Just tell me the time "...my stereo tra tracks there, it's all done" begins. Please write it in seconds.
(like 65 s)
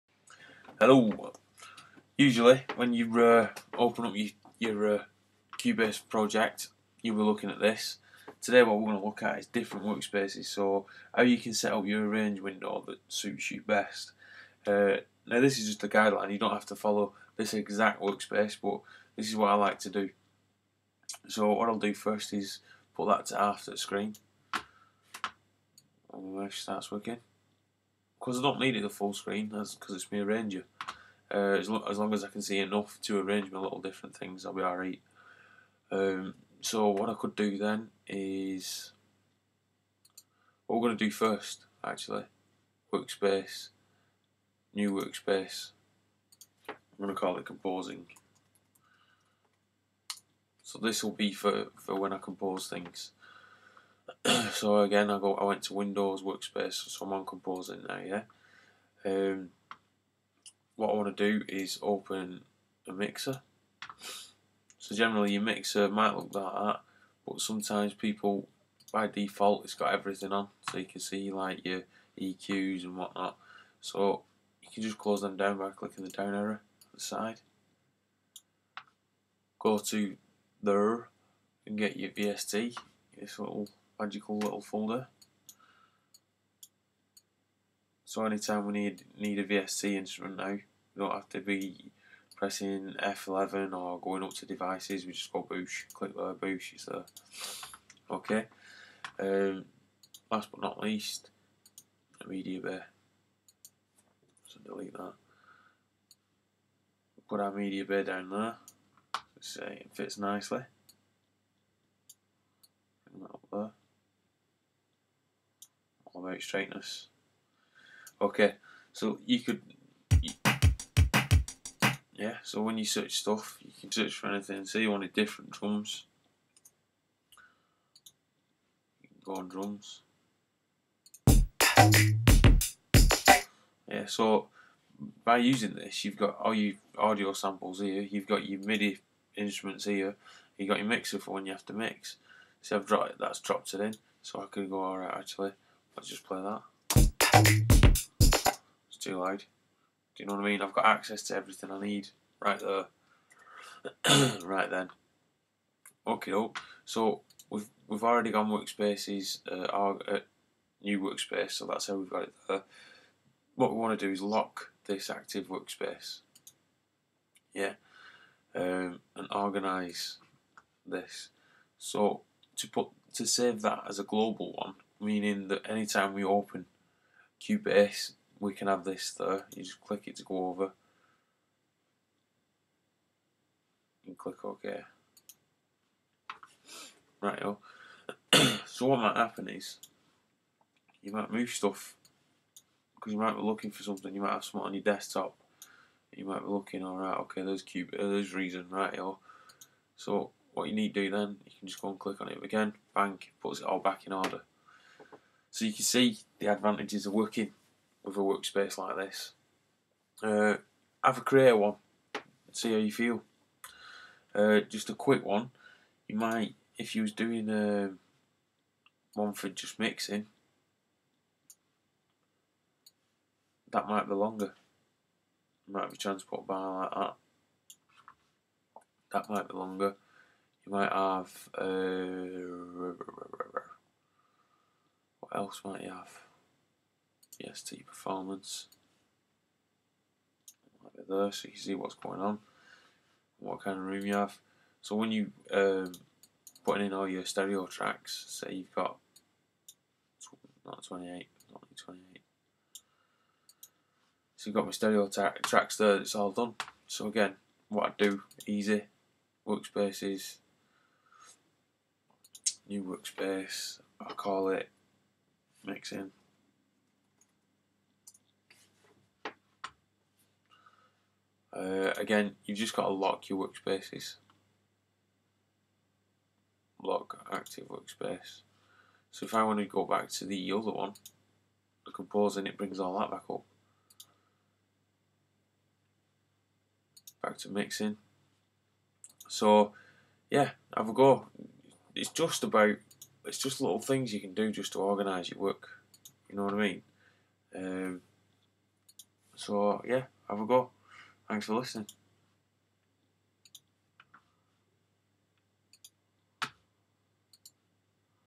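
254 s.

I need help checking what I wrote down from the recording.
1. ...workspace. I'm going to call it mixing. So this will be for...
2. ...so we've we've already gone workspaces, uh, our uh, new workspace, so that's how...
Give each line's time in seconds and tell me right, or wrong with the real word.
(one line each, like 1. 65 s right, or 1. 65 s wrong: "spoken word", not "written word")
1. 44 s wrong: "composing", not "mixing"
2. 156 s right.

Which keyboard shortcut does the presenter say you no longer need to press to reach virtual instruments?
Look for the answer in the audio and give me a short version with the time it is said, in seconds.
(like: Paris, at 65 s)
F11, at 93 s.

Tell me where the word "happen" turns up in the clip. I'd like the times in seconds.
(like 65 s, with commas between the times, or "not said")
189 s.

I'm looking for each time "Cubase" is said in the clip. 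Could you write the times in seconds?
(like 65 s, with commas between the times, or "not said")
5 s, 177 s.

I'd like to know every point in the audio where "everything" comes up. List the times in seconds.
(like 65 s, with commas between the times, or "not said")
69 s, 151 s.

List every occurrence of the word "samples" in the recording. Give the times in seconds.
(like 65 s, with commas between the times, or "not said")
137 s.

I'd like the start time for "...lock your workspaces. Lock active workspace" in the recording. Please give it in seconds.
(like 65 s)
272 s.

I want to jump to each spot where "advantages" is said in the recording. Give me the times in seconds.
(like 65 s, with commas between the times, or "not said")
206 s.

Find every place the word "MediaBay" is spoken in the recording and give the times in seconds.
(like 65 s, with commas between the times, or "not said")
102 s, 107 s.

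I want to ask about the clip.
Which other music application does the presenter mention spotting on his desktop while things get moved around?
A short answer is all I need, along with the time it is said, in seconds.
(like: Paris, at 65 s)
Reason, at 198 s.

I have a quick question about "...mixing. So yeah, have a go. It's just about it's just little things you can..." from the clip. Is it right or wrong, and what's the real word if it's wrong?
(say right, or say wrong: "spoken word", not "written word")
right.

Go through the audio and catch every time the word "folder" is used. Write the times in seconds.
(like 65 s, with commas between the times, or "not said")
84 s.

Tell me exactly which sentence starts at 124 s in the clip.
Say you wanted different drums, go on drums.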